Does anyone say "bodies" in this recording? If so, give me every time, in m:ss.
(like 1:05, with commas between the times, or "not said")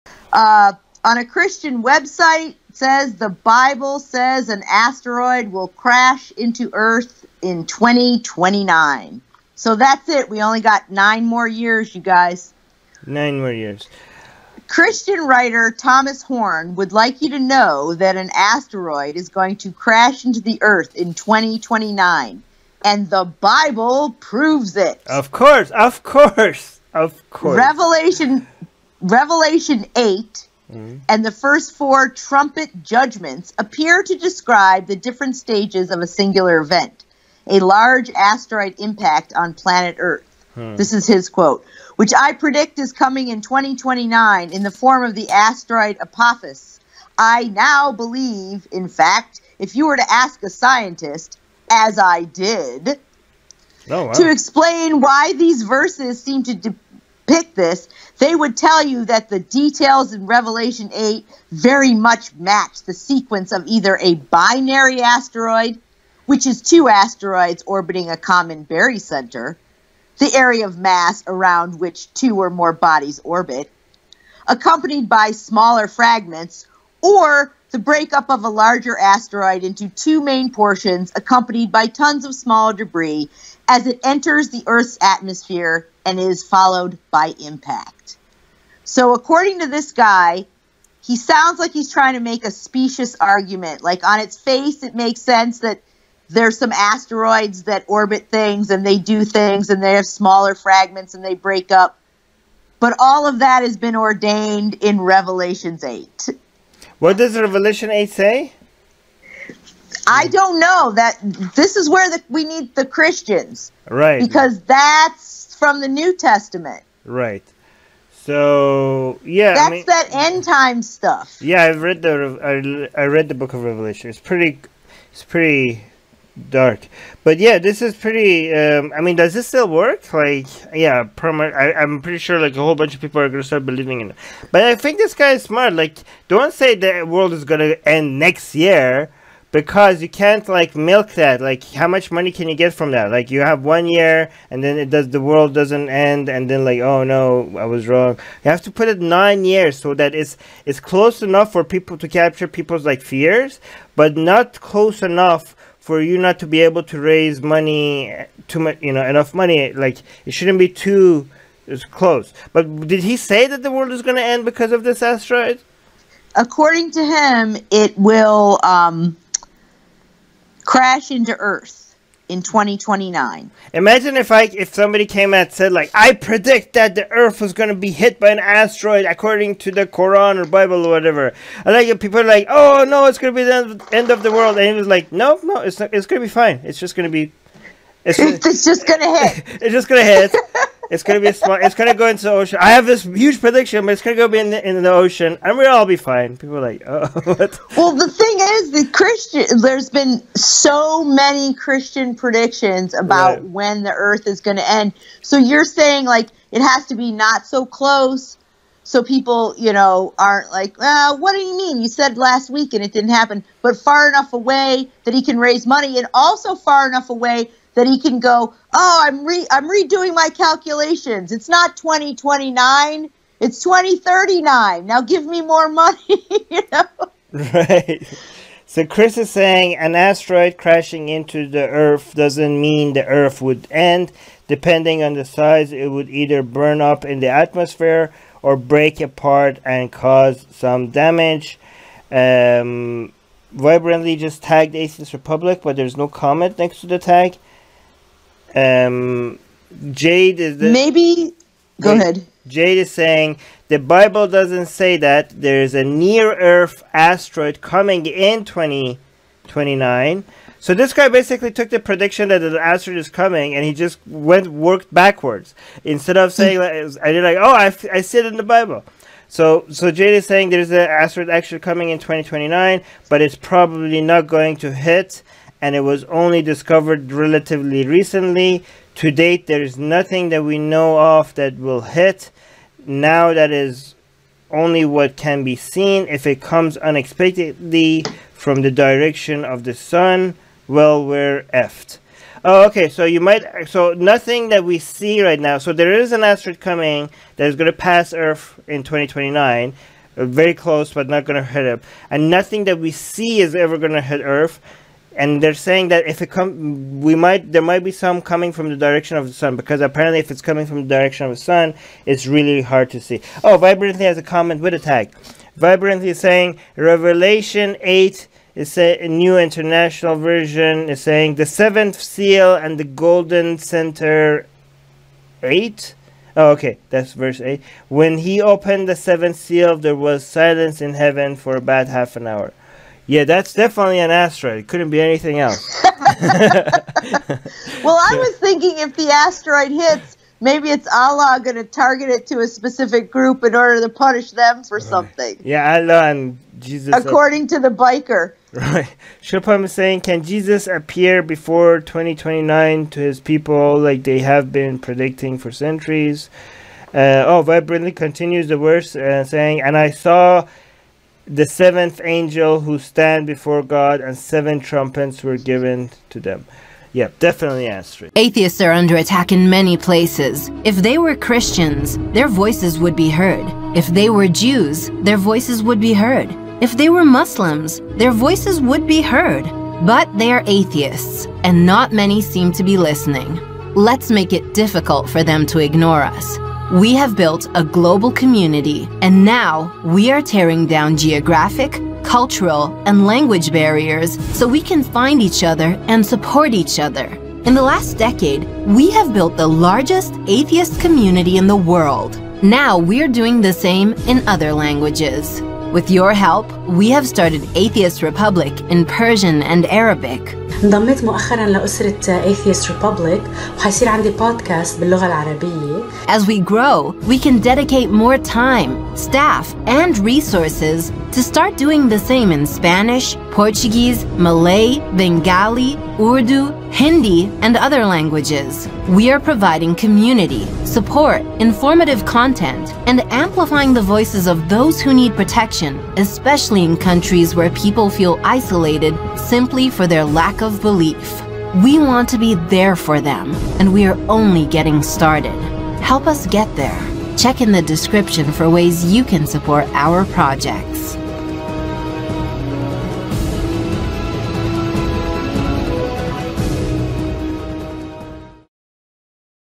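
1:12.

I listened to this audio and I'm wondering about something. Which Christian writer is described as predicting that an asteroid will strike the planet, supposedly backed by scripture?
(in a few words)
Thomas Horn.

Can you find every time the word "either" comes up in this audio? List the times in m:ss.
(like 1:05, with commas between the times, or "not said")
1:03, 3:56.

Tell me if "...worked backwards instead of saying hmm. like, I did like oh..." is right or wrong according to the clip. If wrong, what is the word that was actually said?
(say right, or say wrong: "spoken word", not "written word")
right.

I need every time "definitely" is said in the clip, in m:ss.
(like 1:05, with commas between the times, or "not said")
5:33, 6:07.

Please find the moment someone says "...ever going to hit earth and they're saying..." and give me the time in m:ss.
5:03.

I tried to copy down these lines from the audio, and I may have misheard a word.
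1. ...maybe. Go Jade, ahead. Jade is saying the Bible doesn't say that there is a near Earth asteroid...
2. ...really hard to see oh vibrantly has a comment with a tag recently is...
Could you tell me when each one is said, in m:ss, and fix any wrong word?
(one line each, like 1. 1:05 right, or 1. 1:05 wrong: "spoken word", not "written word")
1. 4:10 right
2. 5:12 wrong: "vibrantly", not "recently".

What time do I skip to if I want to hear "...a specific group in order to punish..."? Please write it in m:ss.
5:42.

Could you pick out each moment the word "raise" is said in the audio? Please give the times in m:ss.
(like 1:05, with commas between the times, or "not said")
2:37, 3:35.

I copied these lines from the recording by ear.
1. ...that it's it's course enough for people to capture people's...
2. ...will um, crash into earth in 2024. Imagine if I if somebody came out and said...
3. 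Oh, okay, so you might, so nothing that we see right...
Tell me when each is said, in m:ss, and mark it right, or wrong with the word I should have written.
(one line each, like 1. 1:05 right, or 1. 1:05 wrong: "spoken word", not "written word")
1. 2:29 wrong: "close", not "course"
2. 2:47 wrong: "2029", not "2024"
3. 4:52 right.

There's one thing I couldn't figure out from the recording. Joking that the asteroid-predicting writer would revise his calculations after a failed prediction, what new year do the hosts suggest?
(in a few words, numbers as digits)
2039.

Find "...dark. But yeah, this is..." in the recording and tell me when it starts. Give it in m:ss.
2:06.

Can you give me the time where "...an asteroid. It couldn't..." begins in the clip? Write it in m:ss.
5:33.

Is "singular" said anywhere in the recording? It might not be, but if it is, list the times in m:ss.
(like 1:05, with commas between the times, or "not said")
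0:36.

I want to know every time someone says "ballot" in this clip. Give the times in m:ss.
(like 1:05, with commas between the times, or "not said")
not said.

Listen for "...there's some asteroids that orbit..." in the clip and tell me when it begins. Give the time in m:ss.
1:36.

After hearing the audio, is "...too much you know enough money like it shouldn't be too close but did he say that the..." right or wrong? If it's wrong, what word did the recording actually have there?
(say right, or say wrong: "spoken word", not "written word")
right.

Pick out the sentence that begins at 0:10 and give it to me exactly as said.
We only got nine more years, you guys.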